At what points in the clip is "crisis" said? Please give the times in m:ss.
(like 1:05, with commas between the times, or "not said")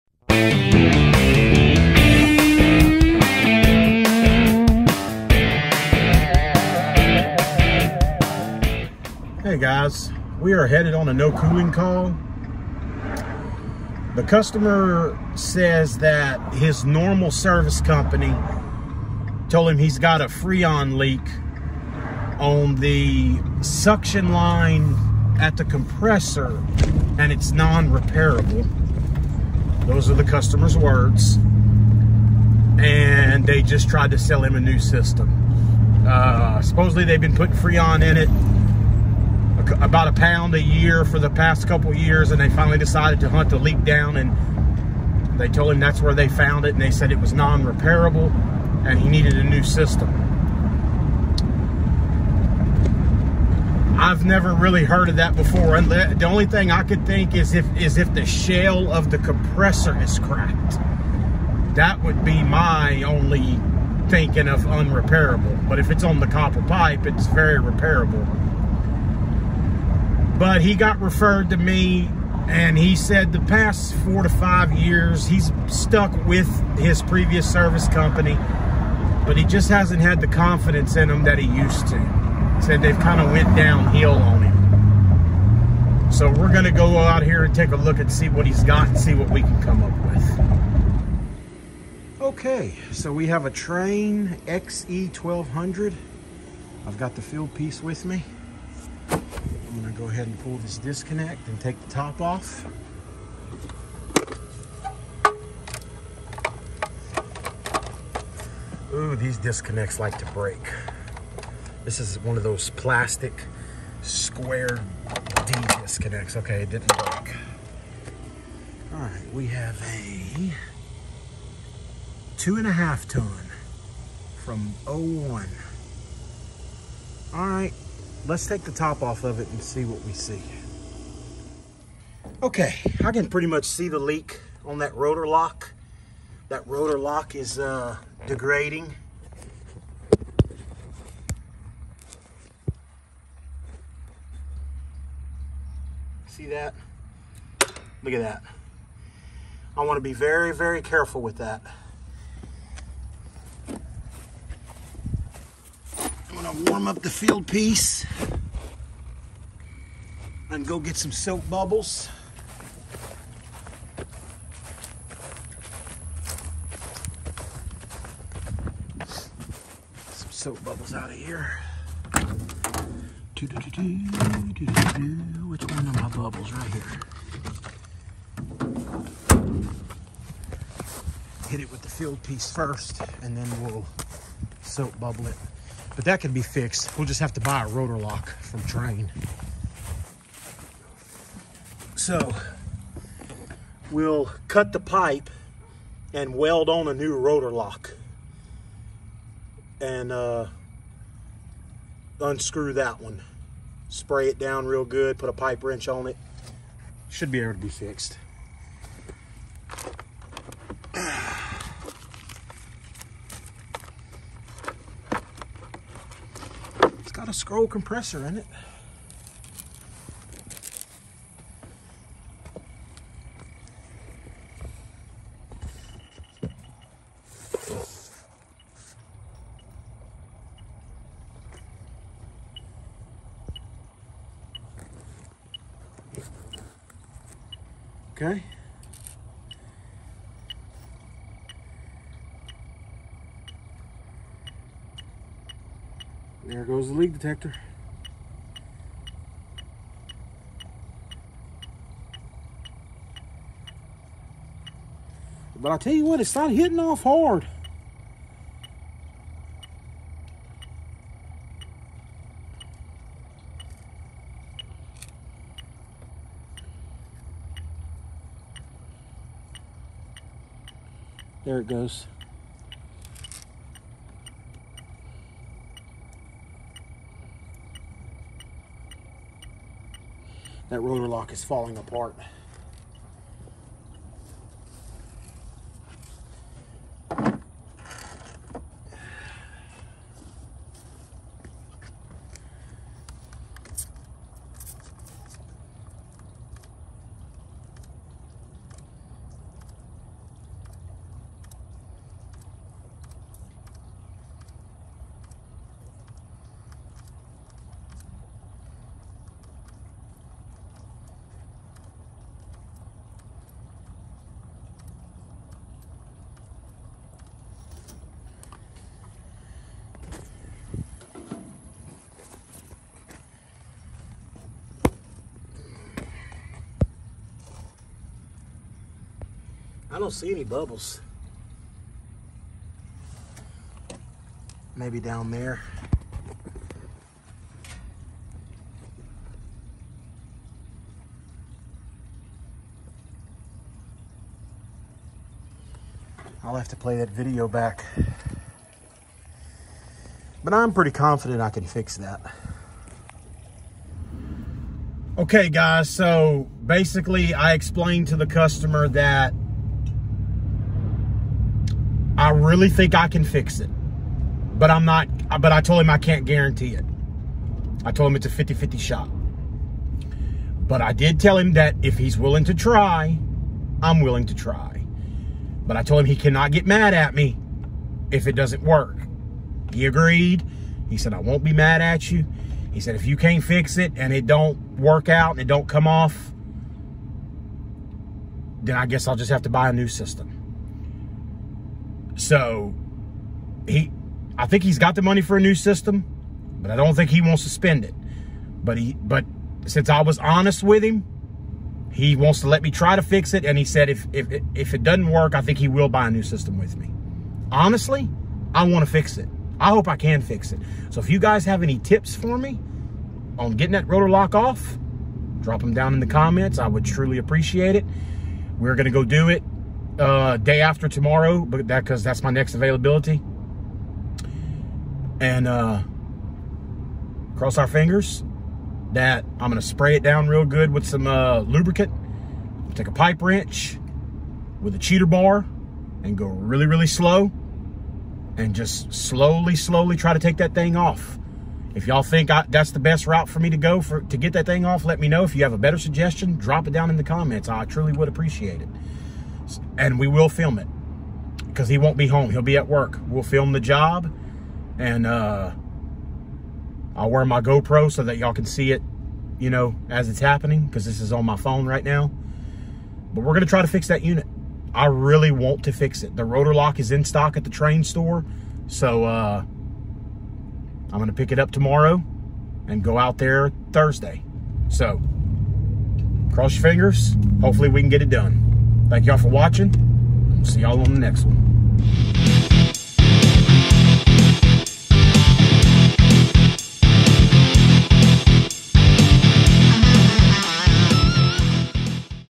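not said.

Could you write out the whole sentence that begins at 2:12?
Okay, I can pretty much see the leak on that Rotolock.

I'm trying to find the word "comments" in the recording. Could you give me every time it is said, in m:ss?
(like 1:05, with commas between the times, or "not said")
6:56, 7:27.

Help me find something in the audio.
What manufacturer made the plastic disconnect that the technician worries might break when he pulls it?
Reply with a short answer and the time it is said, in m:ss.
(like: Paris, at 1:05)
Square D, at 1:54.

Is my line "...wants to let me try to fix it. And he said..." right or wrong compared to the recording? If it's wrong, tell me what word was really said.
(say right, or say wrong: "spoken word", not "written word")
right.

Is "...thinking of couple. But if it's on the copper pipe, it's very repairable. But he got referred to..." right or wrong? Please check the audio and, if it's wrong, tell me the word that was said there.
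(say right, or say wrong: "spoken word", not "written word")
wrong: "unrepairable", not "couple".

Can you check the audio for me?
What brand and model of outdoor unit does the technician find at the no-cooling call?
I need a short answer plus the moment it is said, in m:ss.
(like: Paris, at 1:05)
Trane XE1200, at 1:33.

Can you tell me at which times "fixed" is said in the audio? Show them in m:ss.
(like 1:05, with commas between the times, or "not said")
3:06, 3:27.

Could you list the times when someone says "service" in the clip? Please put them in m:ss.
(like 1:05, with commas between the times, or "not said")
0:17, 1:17.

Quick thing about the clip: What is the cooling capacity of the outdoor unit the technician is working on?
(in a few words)
2.5 ton.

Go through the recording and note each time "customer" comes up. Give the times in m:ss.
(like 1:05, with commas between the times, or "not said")
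0:14, 0:30, 5:58.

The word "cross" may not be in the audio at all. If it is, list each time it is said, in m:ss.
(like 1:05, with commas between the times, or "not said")
7:07, 7:56.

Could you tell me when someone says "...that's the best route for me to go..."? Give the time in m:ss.
7:22.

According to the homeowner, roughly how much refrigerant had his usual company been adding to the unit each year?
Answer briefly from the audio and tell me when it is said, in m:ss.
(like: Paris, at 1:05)
a pound, at 0:40.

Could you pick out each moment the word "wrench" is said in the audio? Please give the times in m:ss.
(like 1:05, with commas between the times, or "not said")
3:25, 7:13.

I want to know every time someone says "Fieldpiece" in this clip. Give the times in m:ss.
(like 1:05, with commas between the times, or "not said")
1:37, 2:37, 3:01.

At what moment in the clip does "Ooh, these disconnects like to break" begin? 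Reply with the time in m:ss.
1:48.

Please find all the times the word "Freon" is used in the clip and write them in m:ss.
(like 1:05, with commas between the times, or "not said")
0:20, 0:37.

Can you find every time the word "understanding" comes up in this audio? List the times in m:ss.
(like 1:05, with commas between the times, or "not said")
not said.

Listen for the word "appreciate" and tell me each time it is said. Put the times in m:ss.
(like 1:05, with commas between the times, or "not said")
6:57, 7:28.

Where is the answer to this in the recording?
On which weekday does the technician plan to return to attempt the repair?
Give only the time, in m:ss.
7:53.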